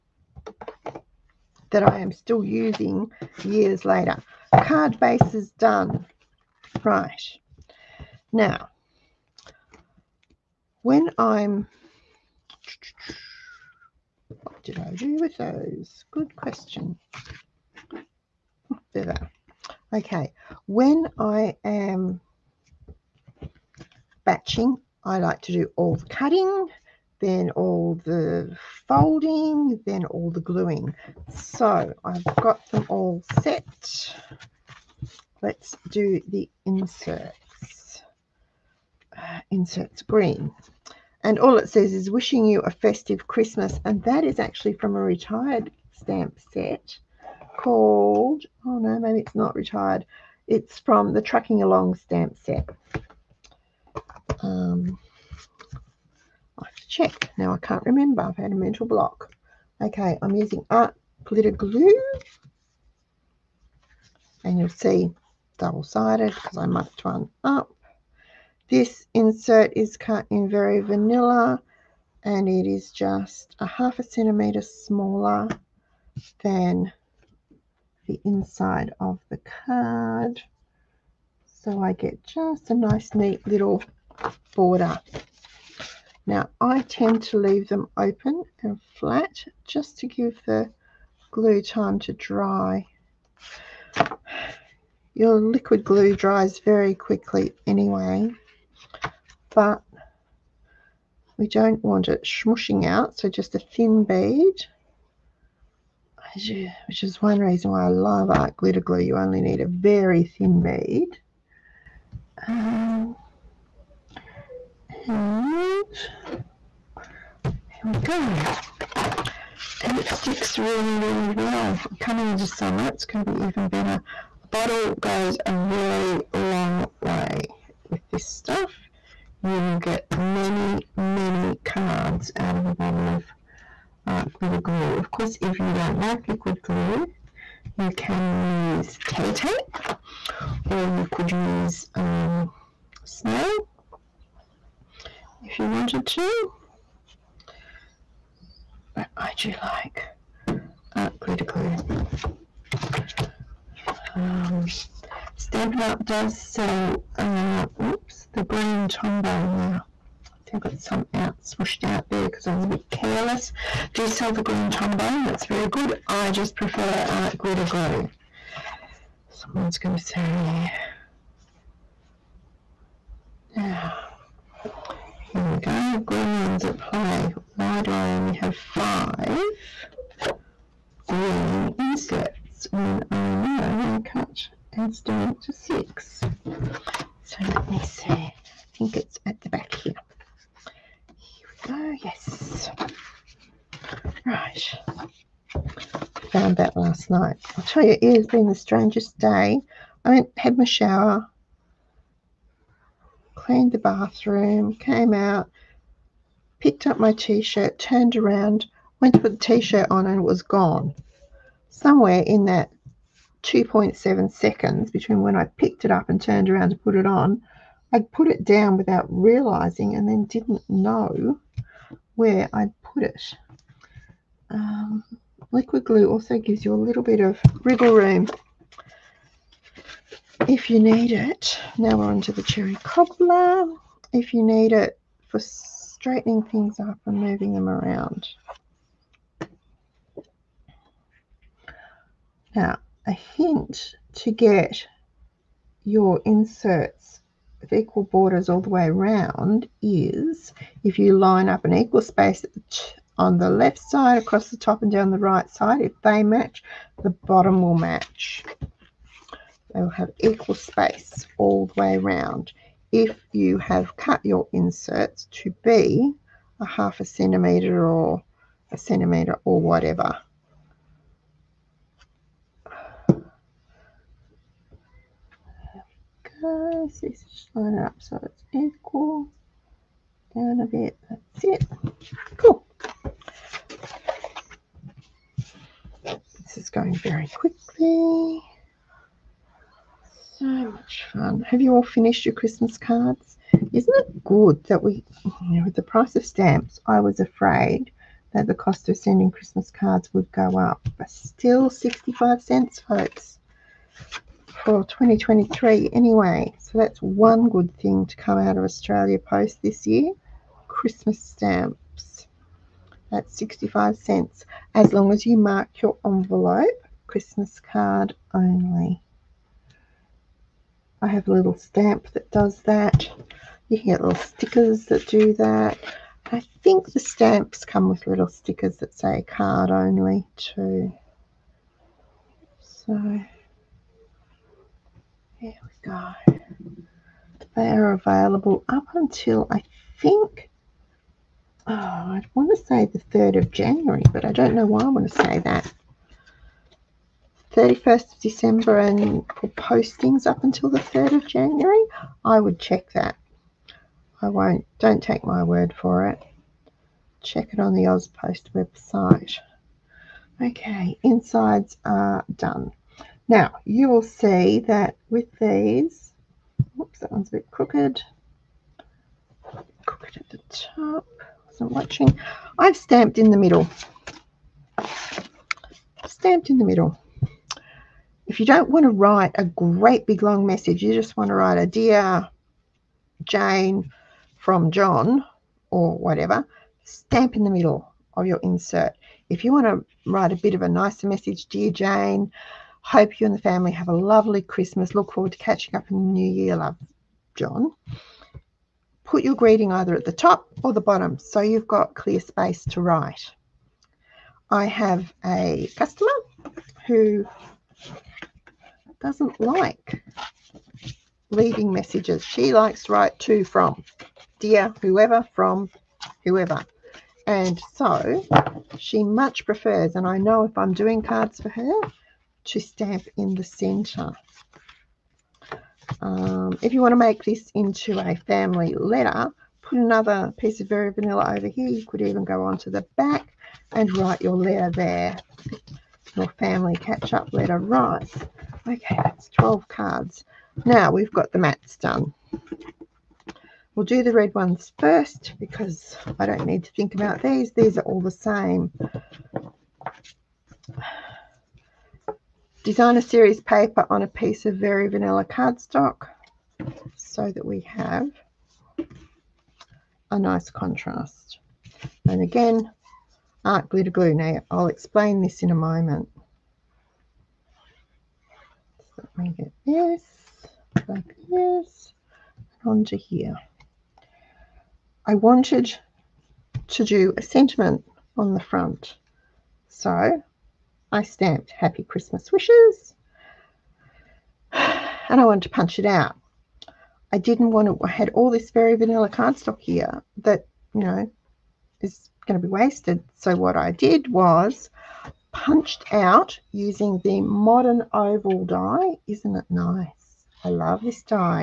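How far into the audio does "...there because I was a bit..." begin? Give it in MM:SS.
02:42.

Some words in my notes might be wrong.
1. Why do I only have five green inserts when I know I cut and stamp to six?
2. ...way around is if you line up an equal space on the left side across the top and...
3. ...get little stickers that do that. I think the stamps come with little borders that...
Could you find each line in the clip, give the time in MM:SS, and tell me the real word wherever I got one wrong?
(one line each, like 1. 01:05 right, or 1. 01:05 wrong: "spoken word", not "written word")
1. 02:57 right
2. 04:08 right
3. 05:23 wrong: "stickers", not "borders".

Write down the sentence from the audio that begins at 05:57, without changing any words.
Check it on the AusPost website.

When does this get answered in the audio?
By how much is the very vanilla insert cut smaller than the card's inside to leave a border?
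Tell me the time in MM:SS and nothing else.
01:13.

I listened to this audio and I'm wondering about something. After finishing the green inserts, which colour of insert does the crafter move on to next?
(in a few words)
cherry cobbler.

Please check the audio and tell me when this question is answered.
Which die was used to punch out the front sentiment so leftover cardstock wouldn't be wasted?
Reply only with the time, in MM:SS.
08:17.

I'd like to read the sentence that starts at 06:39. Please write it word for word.
Put your greeting either at the top or the bottom so you've got clear space to write.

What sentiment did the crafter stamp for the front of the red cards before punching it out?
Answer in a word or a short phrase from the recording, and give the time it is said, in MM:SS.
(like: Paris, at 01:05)
Happy Christmas Wishes, at 08:01.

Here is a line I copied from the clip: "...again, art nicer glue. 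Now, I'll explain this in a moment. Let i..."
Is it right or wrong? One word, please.
wrong.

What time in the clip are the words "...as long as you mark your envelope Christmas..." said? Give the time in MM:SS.
05:14.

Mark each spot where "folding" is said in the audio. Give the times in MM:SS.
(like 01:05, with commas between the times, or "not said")
00:28.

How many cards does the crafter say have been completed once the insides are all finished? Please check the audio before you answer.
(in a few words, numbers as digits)
12.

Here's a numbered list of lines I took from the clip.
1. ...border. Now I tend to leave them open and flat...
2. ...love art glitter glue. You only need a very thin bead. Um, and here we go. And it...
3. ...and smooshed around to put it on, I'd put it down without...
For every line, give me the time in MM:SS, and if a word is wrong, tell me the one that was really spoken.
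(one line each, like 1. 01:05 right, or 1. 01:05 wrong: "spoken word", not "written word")
1. 01:24 right
2. 01:47 right
3. 03:36 wrong: "turned", not "smooshed".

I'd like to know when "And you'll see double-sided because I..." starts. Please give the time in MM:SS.
01:04.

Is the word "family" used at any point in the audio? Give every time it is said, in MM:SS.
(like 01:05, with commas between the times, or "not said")
06:33, 07:08, 07:16.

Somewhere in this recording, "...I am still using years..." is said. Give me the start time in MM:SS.
00:01.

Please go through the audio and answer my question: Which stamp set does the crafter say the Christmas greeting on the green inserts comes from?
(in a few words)
Trucking Along.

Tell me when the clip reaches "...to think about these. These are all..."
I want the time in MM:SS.
07:26.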